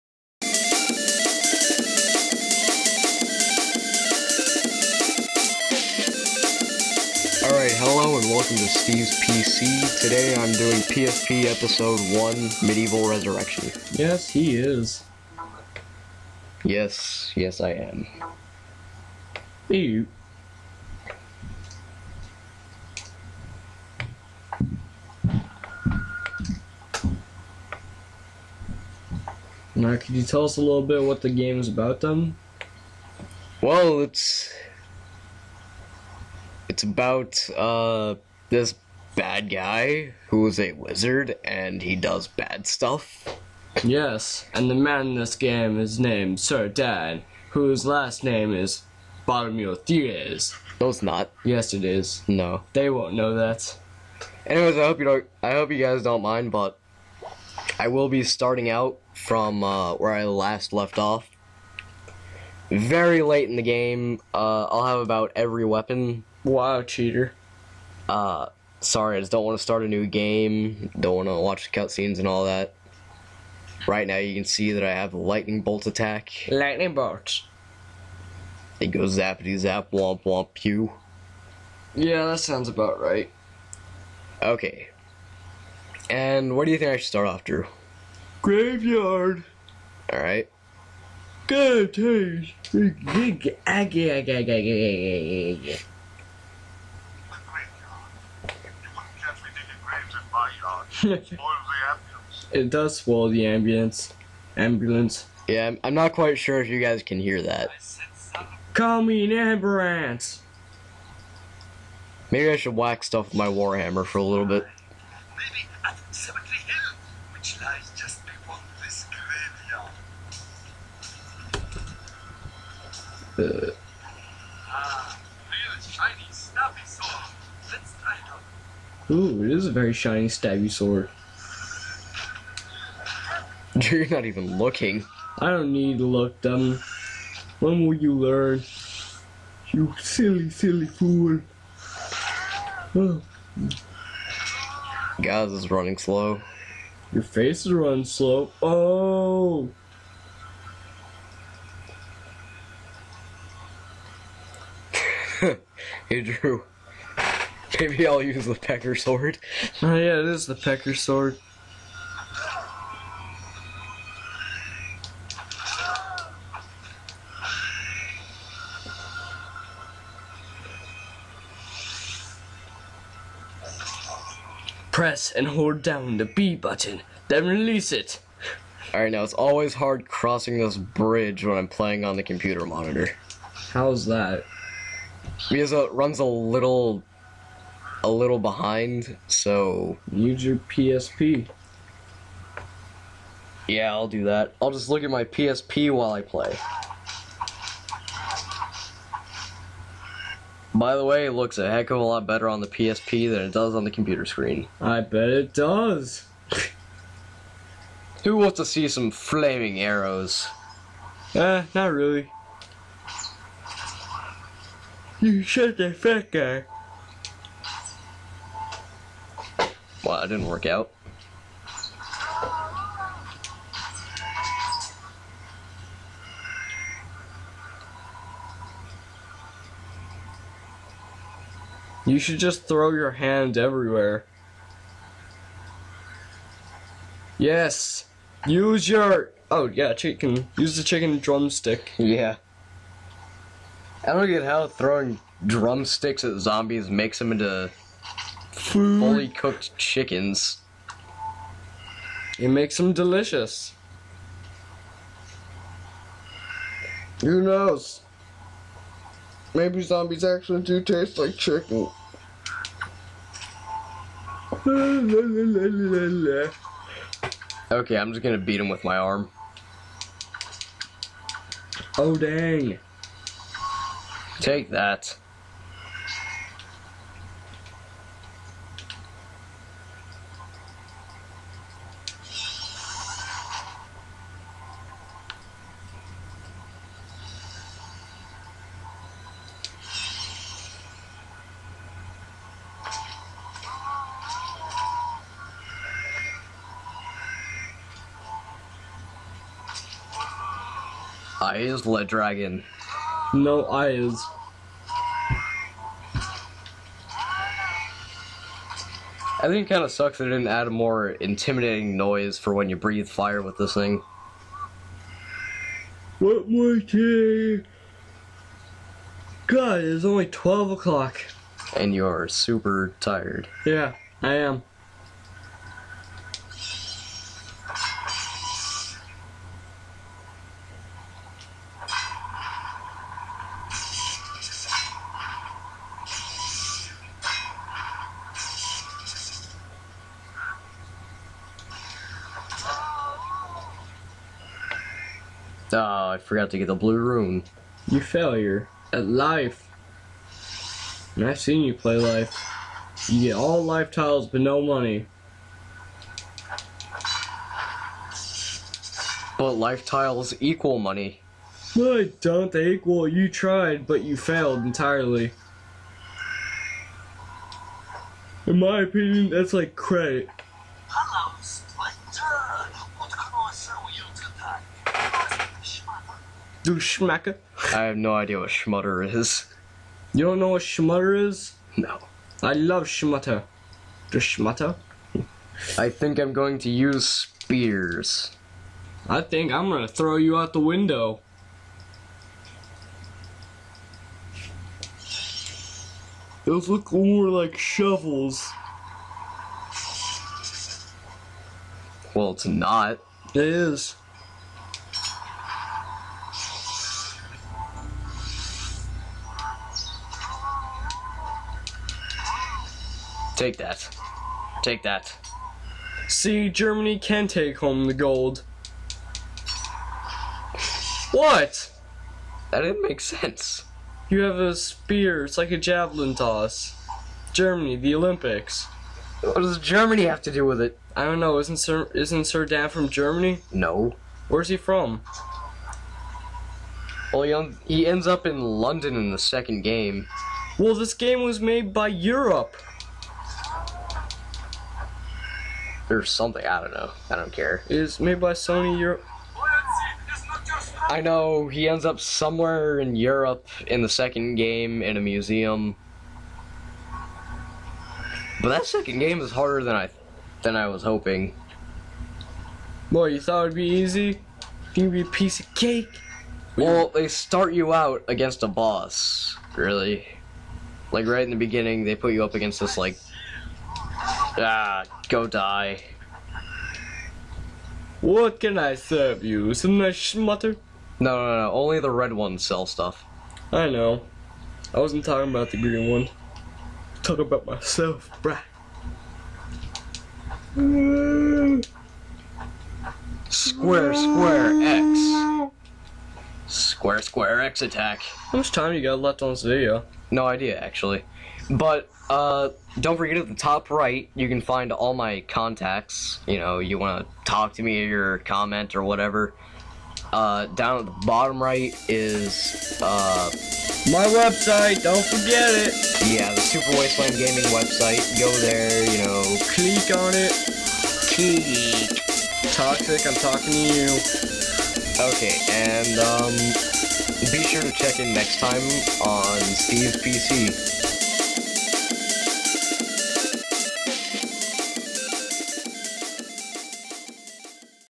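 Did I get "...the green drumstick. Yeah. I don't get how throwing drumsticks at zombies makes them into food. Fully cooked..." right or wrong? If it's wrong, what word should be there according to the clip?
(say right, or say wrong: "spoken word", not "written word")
wrong: "chicken", not "green".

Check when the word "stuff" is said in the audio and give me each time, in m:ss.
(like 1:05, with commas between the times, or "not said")
0:42, 1:53, 8:02.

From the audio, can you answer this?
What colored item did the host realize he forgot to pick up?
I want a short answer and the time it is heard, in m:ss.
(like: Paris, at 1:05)
Blue rune, at 5:46.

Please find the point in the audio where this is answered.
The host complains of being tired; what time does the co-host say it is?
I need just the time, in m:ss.
5:20.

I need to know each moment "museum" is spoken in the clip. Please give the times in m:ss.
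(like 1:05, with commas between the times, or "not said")
7:35.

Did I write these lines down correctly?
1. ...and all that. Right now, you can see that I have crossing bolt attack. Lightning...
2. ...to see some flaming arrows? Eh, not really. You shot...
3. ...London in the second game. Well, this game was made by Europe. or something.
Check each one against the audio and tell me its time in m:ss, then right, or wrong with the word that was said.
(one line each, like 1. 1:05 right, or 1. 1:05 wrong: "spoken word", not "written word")
1. 1:12 wrong: "lightning", not "crossing"
2. 3:28 right
3. 7:18 right.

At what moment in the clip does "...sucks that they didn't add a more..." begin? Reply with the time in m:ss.
5:09.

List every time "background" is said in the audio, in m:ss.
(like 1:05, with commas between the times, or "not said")
not said.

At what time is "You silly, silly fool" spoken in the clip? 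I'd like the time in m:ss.
2:19.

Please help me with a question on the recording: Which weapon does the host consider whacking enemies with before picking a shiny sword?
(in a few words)
Warhammer.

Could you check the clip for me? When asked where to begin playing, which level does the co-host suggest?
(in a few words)
Graveyard.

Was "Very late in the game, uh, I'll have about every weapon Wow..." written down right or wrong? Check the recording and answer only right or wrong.
right.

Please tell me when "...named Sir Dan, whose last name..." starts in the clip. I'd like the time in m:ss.
0:45.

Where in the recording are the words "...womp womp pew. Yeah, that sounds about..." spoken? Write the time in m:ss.
1:19.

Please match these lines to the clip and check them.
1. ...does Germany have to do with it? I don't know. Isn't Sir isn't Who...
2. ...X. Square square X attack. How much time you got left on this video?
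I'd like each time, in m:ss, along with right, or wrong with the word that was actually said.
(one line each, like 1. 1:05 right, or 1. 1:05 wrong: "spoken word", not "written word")
1. 7:09 wrong: "Sir", not "Who"
2. 8:14 right.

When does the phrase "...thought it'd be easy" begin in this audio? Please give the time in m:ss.
7:43.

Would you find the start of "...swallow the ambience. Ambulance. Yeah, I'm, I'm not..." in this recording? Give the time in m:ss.
1:42.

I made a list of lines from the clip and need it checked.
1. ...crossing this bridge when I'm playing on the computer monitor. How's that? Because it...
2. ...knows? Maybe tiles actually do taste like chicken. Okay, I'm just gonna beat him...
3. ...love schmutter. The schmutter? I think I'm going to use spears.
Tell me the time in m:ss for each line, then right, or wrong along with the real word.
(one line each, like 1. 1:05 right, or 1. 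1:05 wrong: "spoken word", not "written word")
1. 3:00 right
2. 4:17 wrong: "zombies", not "tiles"
3. 6:22 right.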